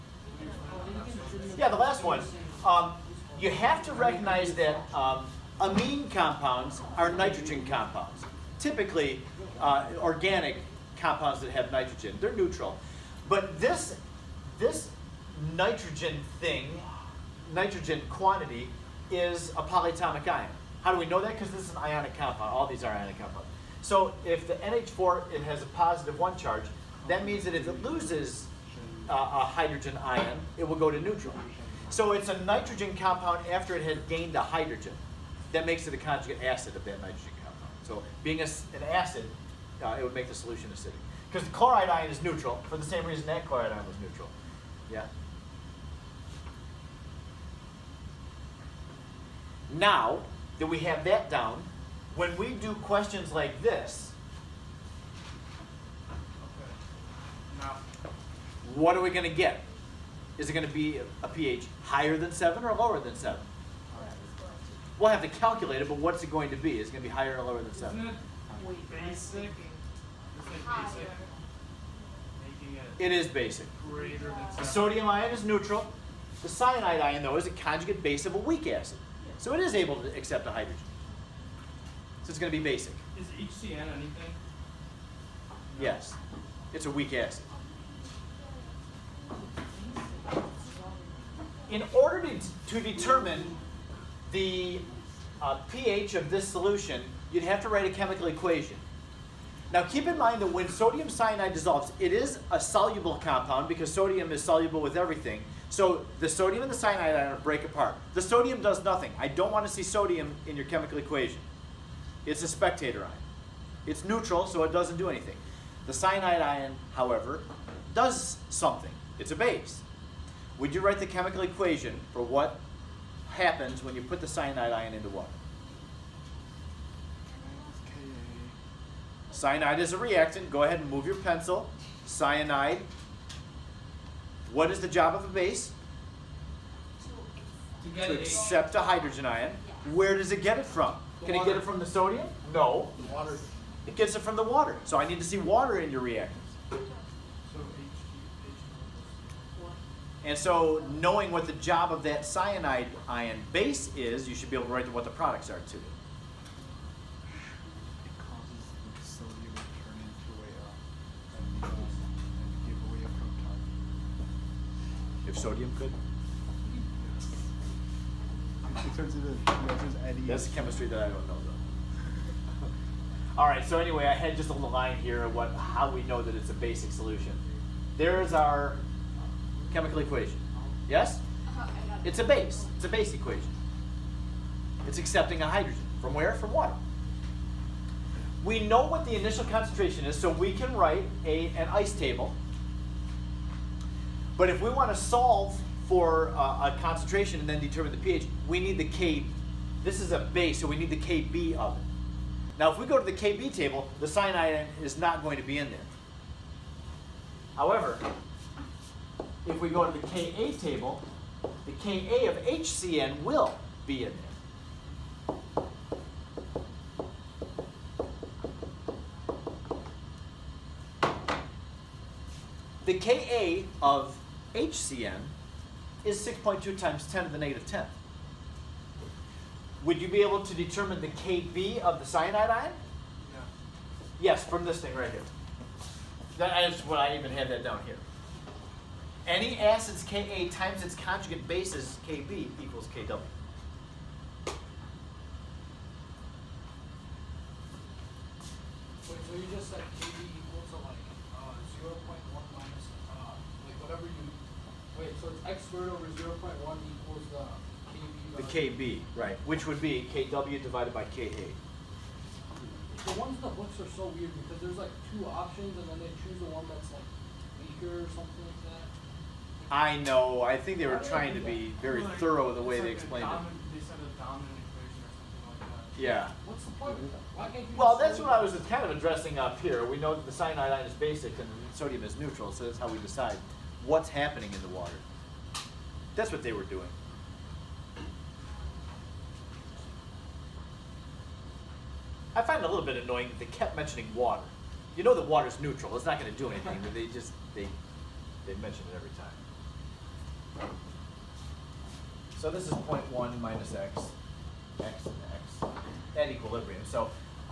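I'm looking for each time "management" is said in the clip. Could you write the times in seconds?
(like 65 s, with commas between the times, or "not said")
not said.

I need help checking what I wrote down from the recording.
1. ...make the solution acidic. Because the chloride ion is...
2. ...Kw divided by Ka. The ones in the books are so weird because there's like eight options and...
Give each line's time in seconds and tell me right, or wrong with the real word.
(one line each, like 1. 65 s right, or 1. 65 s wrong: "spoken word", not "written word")
1. 40 s right
2. 260 s wrong: "two", not "eight".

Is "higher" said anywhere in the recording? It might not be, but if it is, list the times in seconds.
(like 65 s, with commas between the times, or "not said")
61 s, 67 s.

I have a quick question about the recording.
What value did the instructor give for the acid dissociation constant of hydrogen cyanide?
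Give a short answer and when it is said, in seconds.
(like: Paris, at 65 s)
6.2 x 10^-10, at 226 s.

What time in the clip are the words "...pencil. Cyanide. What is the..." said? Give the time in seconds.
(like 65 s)
131 s.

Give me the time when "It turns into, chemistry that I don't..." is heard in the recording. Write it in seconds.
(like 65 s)
168 s.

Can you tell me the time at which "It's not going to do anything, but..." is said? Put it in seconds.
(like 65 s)
295 s.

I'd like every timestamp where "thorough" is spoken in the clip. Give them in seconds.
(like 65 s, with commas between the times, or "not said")
272 s.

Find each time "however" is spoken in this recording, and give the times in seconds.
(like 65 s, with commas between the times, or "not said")
116 s, 207 s.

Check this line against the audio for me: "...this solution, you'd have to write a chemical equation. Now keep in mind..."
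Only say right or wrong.
right.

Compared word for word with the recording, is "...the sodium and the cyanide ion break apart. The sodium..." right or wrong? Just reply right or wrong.
right.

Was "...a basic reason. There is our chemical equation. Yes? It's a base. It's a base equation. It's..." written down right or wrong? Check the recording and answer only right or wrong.
wrong.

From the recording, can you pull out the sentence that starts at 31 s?
So it's a nitrogen compound after it has gained a hydrogen.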